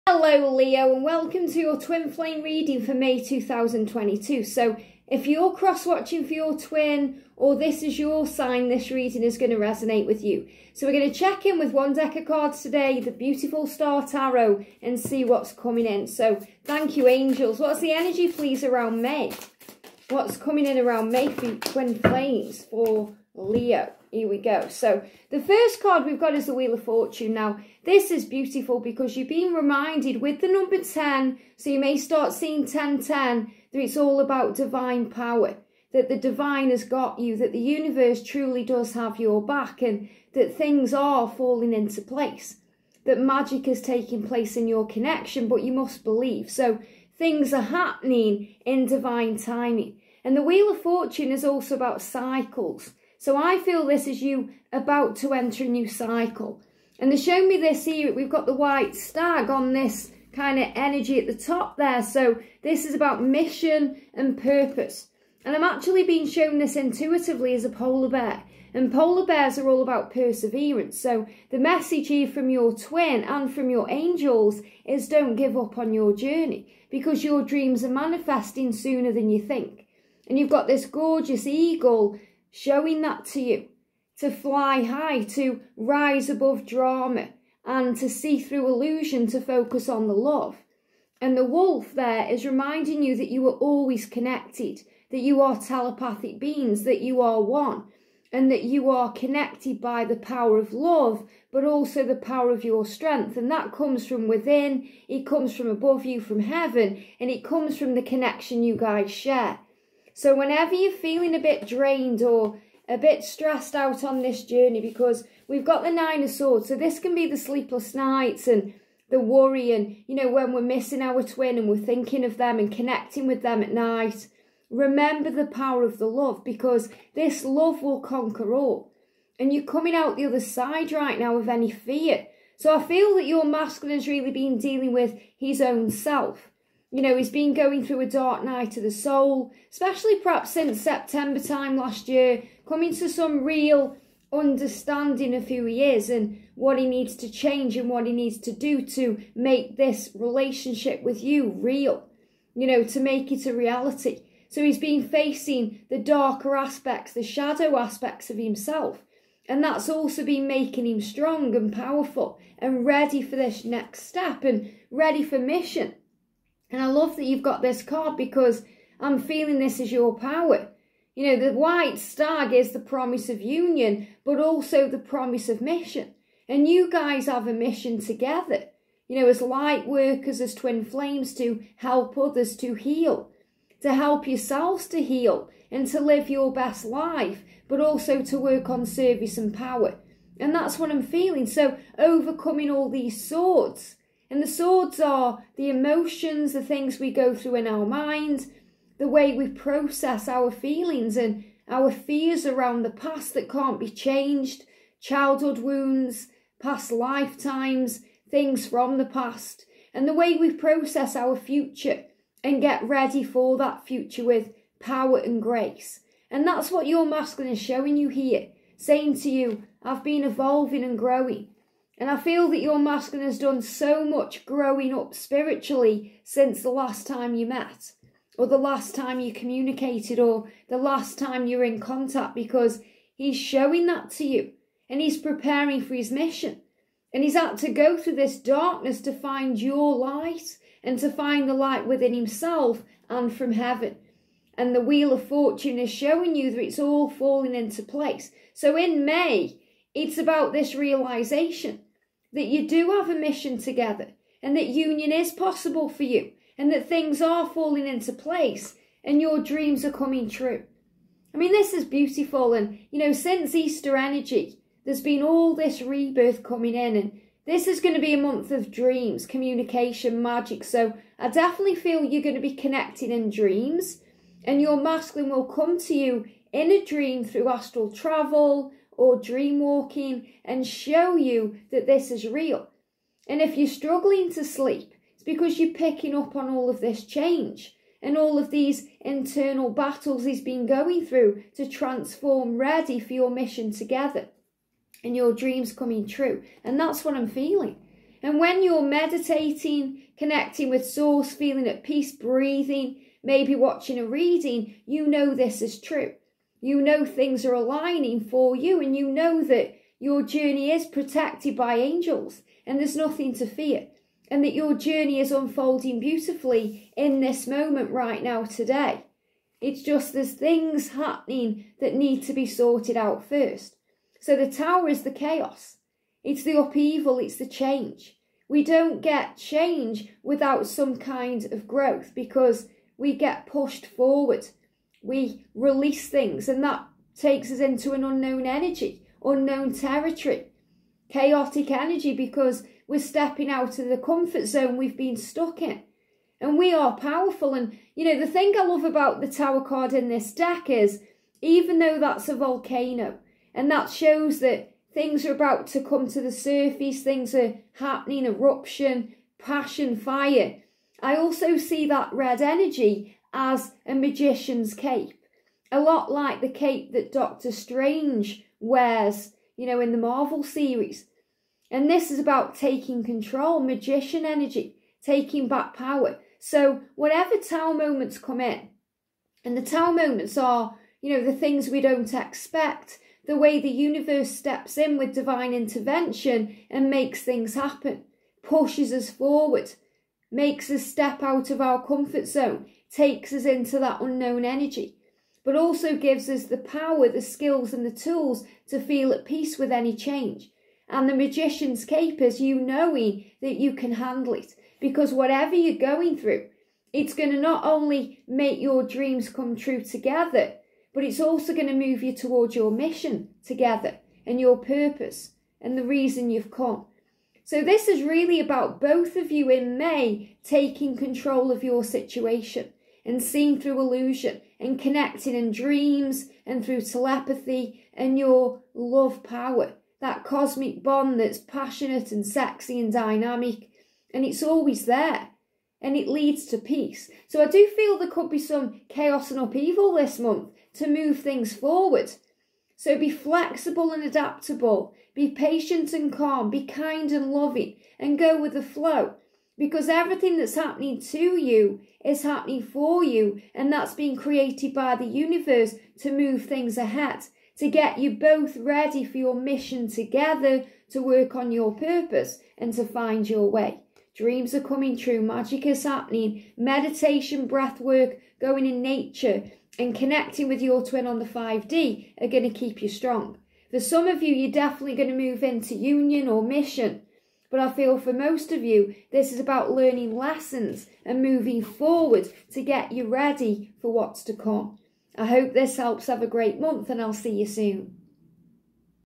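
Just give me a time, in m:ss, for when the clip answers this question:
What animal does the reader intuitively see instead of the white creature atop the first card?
1:07.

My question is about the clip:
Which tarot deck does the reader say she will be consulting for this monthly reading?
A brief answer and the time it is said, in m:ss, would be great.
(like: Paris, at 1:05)
Star Tarot, at 0:13.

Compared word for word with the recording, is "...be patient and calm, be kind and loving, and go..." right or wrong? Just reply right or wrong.
right.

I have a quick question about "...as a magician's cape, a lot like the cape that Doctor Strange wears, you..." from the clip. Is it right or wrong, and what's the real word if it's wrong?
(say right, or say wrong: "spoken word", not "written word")
right.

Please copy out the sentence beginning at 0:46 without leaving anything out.
So things are happening in divine timing.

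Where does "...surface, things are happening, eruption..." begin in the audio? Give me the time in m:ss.
5:56.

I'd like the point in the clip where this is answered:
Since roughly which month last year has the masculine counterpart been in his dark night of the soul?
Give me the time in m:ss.
2:20.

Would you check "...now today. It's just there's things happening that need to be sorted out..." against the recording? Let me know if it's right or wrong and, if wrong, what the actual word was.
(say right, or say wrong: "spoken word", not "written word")
right.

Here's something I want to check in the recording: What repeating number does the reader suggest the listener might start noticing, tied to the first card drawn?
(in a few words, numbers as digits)
1010.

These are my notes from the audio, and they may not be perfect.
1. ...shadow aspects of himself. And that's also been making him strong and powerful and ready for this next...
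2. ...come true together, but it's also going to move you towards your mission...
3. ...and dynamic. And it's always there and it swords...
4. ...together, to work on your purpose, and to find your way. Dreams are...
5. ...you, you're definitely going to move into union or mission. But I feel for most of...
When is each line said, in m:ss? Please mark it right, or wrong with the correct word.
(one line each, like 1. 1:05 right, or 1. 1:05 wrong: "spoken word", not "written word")
1. 2:37 right
2. 6:49 right
3. 7:12 wrong: "leads", not "swords"
4. 7:39 right
5. 7:54 right.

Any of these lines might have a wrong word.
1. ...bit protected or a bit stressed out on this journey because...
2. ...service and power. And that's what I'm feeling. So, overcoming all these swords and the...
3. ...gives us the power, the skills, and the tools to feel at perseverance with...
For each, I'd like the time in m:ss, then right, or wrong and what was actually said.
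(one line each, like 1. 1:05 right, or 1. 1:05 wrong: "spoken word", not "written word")
1. 1:51 wrong: "drained", not "protected"
2. 3:08 right
3. 6:35 wrong: "peace", not "perseverance".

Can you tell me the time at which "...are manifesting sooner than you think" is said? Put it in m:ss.
1:17.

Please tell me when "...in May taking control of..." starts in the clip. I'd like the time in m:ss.
6:59.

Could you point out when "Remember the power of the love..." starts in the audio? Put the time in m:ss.
2:04.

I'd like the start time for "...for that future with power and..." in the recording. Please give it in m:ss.
3:33.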